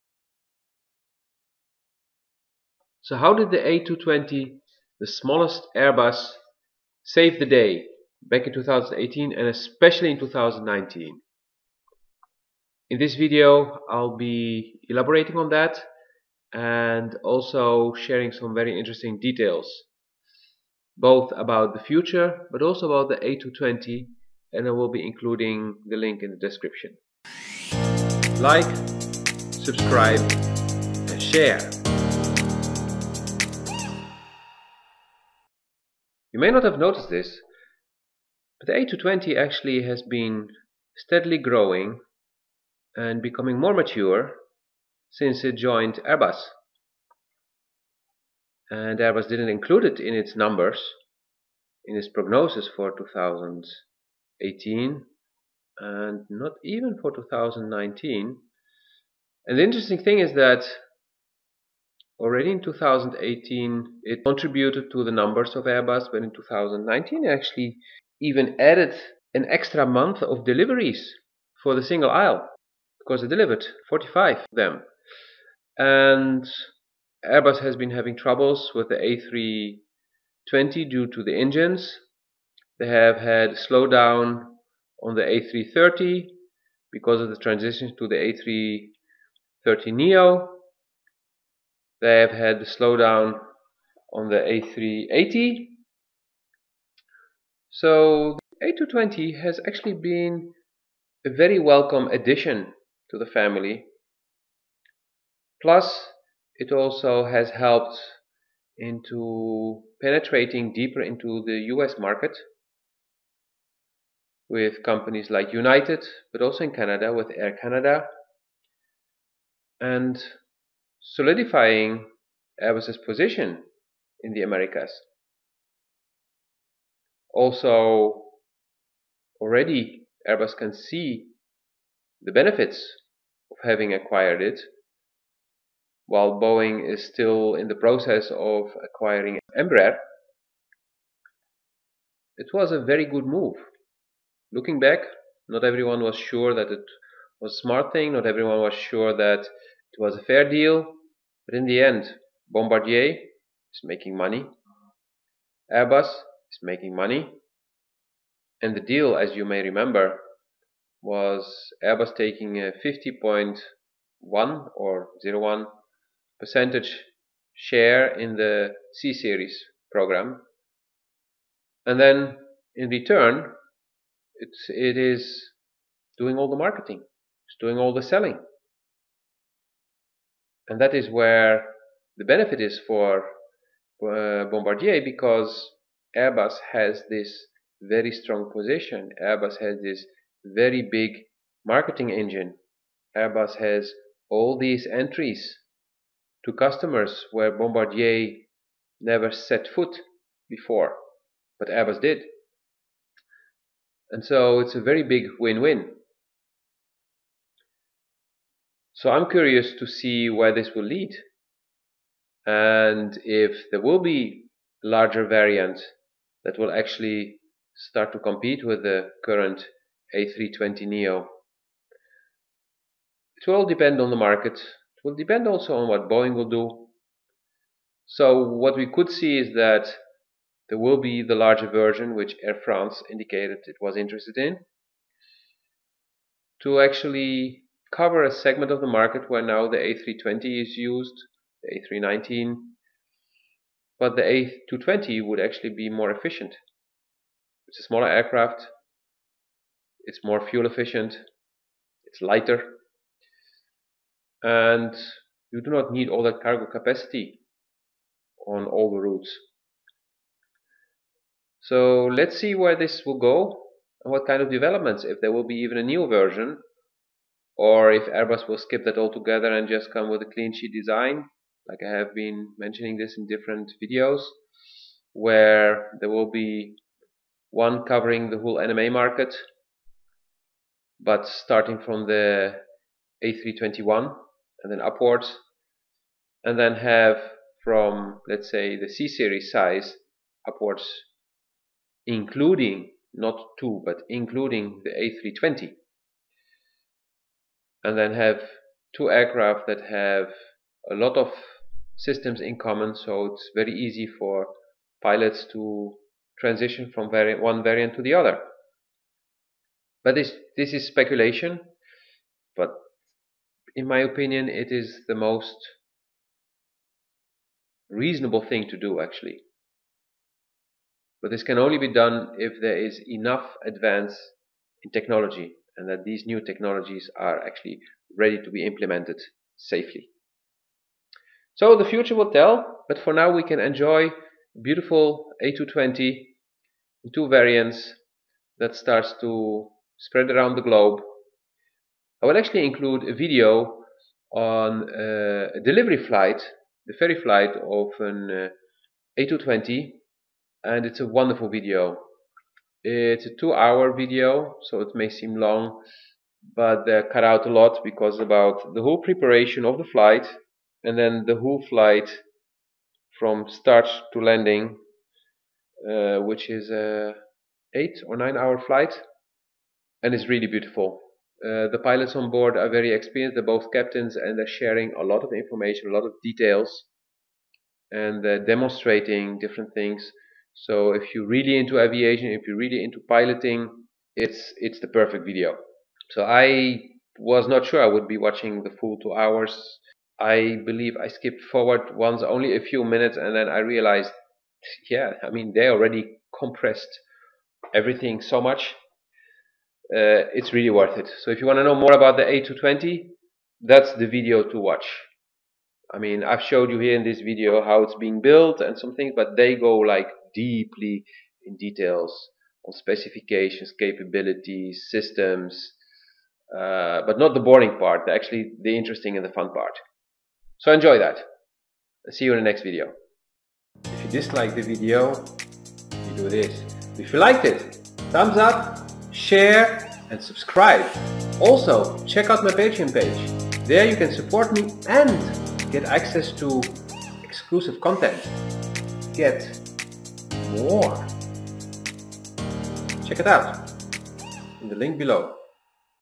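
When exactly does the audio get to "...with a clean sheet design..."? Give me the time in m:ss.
4:30.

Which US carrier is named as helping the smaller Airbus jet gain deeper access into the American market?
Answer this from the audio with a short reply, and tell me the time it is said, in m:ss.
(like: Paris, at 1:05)
United, at 1:55.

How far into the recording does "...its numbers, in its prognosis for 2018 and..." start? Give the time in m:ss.
0:50.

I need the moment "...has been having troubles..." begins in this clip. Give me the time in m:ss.
1:17.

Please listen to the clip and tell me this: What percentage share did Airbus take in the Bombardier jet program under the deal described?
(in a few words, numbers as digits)
50.1 percent.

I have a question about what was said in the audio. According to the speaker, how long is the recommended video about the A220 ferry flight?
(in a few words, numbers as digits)
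2 hours.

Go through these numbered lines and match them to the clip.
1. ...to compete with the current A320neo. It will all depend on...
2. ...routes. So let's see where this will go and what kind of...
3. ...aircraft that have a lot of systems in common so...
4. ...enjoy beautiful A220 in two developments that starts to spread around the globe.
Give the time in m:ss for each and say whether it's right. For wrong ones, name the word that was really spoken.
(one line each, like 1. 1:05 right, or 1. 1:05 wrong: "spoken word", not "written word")
1. 3:38 right
2. 4:18 right
3. 4:59 right
4. 5:33 wrong: "variants", not "developments".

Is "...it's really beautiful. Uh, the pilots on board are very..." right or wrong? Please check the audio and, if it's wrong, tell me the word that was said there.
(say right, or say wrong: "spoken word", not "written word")
right.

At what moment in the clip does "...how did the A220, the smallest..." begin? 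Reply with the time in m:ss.
0:03.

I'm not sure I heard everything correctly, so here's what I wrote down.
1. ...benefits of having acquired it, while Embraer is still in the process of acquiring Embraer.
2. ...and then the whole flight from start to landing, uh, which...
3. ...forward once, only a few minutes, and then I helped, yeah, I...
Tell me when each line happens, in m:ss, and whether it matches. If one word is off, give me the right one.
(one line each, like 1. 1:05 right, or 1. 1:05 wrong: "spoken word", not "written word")
1. 2:12 wrong: "Boeing", not "Embraer"
2. 6:00 right
3. 6:31 wrong: "realized", not "helped".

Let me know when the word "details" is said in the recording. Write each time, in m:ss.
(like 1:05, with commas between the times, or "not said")
0:19, 6:16, 6:51.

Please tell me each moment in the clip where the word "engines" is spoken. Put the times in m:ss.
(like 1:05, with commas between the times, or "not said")
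1:21, 3:12.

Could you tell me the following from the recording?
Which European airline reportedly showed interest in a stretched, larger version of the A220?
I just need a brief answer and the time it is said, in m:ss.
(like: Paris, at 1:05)
Air France, at 3:52.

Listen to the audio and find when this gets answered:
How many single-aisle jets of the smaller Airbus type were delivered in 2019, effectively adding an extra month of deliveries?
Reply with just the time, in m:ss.
1:13.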